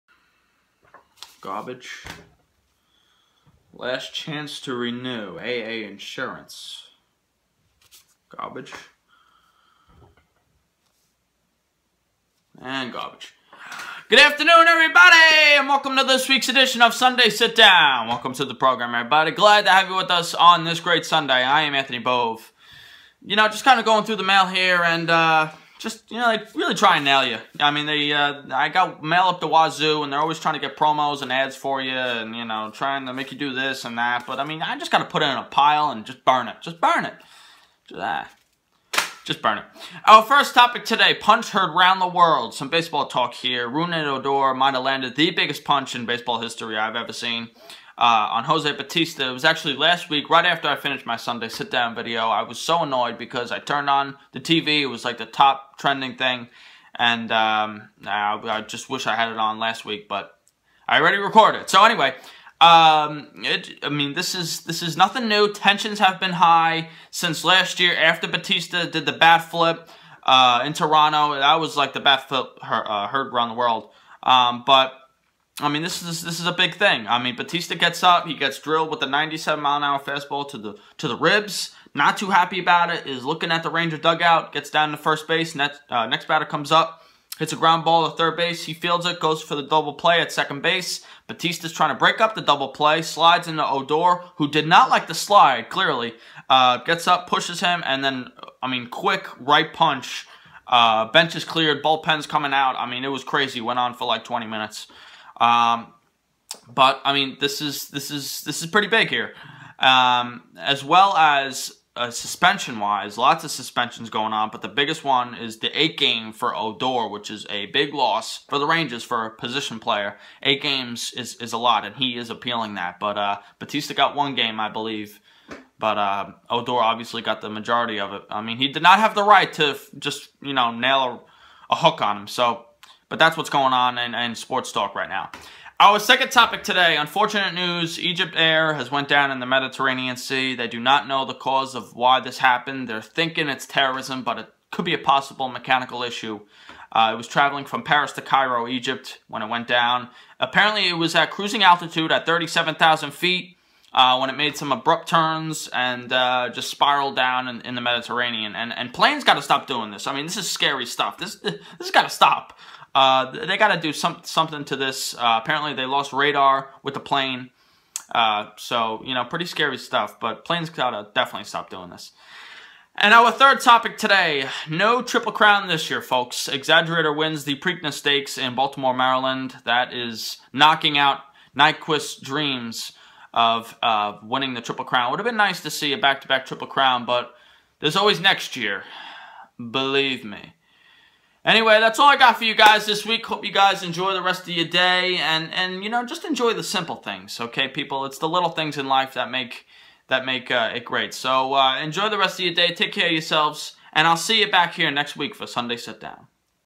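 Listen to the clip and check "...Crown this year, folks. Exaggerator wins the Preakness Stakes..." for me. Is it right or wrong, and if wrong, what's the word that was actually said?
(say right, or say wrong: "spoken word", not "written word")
right.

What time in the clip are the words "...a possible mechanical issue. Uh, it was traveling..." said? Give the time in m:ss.
2:24.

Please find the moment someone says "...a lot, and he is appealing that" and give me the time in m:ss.
2:01.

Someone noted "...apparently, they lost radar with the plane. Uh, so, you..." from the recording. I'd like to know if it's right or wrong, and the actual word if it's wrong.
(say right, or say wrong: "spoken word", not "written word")
right.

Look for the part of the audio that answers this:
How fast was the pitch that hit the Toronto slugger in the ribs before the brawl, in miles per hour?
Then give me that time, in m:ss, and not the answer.
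1:19.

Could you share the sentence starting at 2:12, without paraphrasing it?
So, but that's what's going on in, in sports talk right now.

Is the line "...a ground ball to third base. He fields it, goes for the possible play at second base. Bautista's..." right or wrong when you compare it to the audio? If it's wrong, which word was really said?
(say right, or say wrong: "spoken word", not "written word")
wrong: "double", not "possible".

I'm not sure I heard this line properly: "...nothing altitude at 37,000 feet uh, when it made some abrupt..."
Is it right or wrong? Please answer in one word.
wrong.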